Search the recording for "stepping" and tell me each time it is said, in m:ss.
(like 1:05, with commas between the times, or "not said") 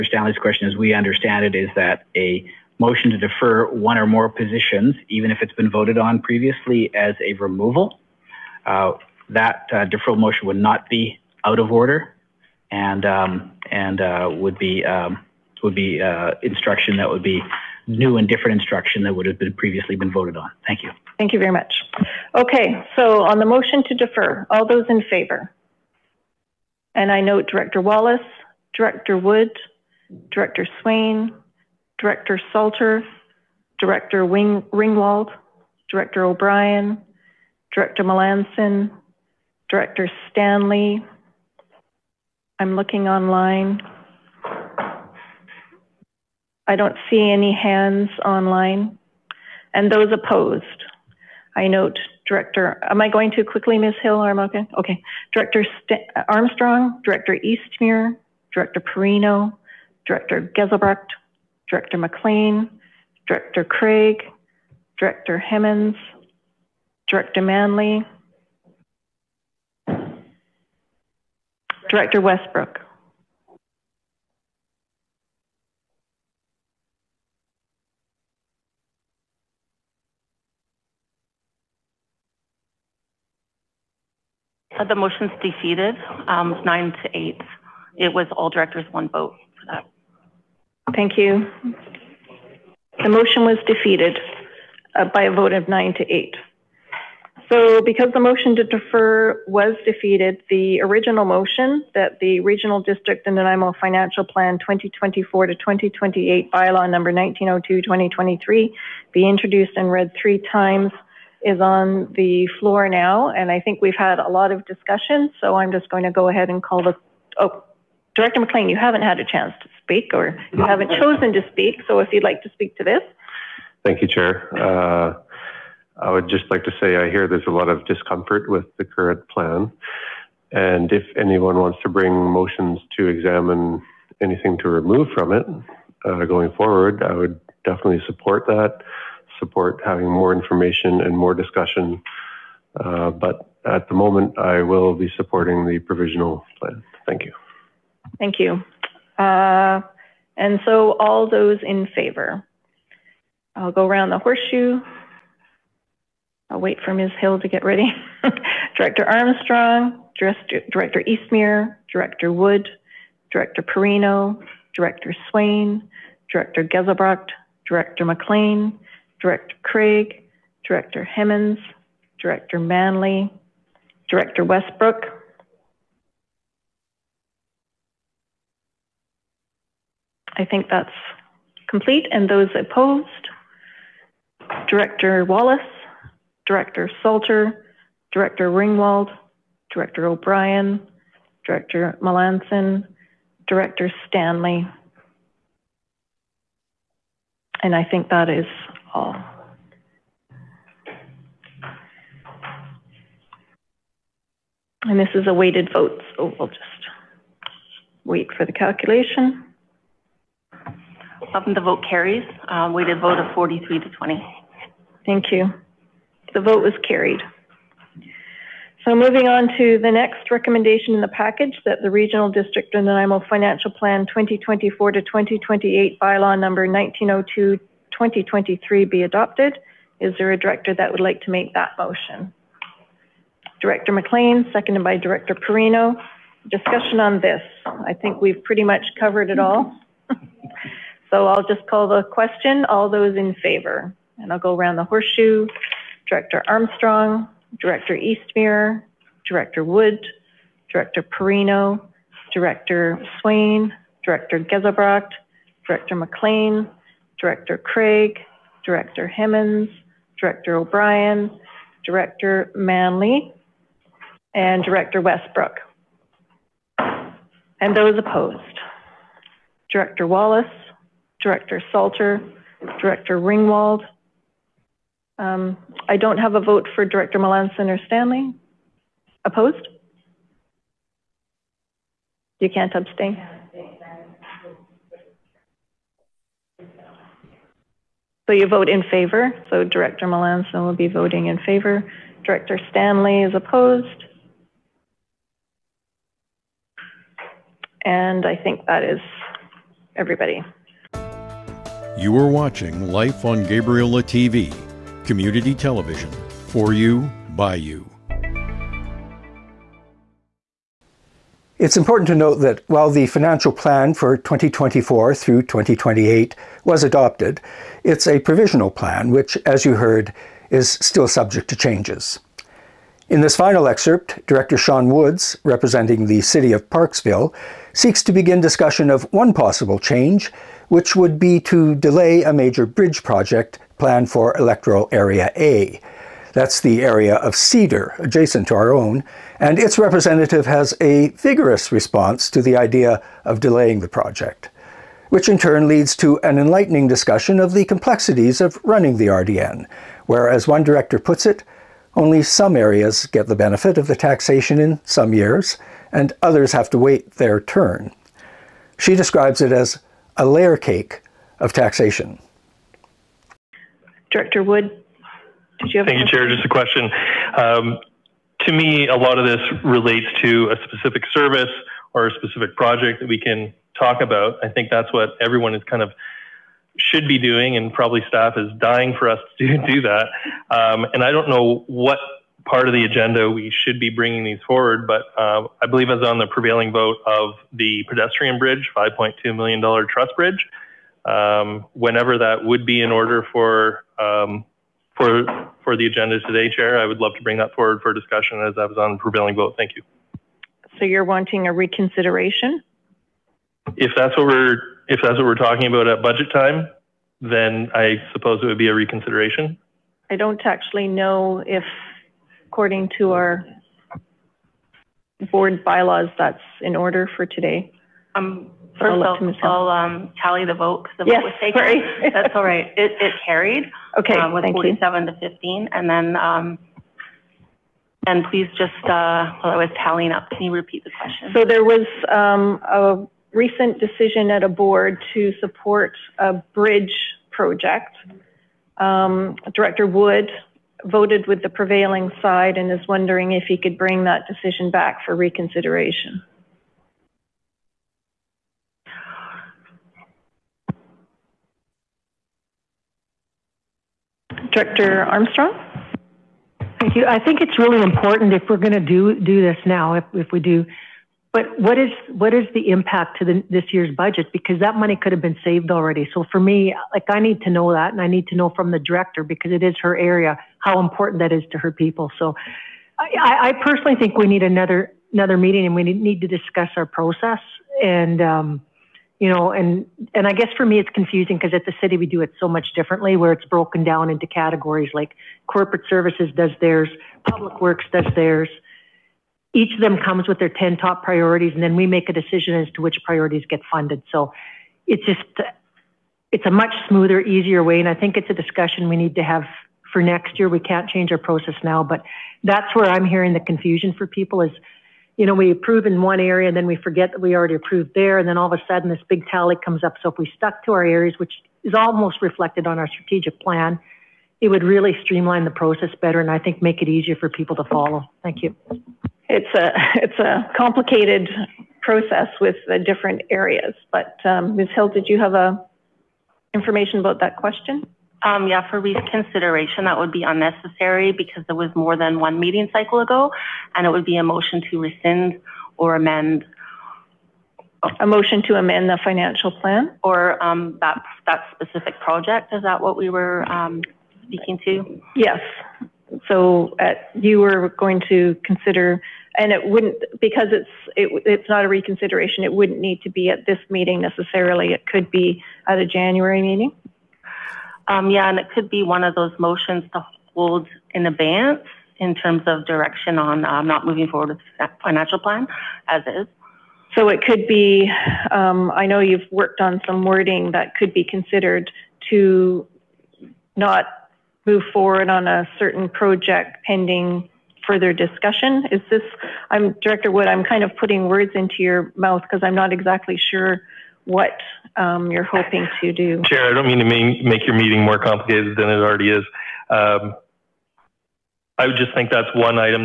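not said.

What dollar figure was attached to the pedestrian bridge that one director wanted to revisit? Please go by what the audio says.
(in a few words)
$5.2 million.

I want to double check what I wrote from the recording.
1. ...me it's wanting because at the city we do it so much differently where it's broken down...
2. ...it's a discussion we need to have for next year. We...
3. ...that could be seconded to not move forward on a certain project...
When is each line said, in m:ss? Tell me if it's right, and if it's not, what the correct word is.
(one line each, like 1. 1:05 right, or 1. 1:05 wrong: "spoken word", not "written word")
1. 8:00 wrong: "confusing", not "wanting"
2. 8:18 right
3. 9:30 wrong: "considered", not "seconded".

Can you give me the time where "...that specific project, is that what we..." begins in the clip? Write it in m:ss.
9:01.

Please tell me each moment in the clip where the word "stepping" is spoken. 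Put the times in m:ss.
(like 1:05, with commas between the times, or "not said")
not said.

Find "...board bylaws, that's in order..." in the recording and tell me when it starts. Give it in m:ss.
6:55.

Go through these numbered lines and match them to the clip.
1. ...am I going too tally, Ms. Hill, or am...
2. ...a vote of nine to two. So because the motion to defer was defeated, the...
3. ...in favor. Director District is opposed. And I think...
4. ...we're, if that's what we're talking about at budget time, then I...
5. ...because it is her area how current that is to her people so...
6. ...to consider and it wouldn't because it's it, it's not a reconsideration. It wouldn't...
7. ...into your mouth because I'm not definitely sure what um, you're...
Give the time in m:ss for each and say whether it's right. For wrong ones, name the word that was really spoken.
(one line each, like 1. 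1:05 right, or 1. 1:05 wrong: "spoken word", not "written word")
1. 0:52 wrong: "quickly", not "tally"
2. 1:35 wrong: "eight", not "two"
3. 4:51 wrong: "Stanley", not "District"
4. 6:44 right
5. 7:49 wrong: "important", not "current"
6. 9:08 right
7. 9:41 wrong: "exactly", not "definitely".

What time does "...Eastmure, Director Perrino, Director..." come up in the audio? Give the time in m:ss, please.
0:57.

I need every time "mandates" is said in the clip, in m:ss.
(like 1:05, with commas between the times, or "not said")
not said.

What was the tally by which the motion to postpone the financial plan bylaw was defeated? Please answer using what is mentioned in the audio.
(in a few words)
9 to 8.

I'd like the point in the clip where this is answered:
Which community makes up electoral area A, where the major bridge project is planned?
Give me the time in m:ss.
5:37.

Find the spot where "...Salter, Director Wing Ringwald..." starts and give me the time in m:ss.
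0:32.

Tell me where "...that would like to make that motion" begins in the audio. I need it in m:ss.
3:50.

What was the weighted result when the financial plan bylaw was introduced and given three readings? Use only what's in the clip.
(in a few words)
43 to 20.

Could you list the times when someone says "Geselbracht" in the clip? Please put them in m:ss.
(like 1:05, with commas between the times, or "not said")
1:00, 2:46, 4:14.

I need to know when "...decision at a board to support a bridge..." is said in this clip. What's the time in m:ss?
7:13.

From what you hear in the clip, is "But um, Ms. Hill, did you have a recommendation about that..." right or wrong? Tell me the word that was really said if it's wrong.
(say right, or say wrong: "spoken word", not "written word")
wrong: "information", not "recommendation".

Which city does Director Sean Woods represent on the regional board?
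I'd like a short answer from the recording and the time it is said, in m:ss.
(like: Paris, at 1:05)
Parksville, at 5:26.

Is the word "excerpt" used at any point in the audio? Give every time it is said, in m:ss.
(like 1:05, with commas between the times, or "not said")
5:23.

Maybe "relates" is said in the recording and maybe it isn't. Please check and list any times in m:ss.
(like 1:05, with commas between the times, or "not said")
6:09.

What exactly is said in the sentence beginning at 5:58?
She describes it as a layer cake of taxation.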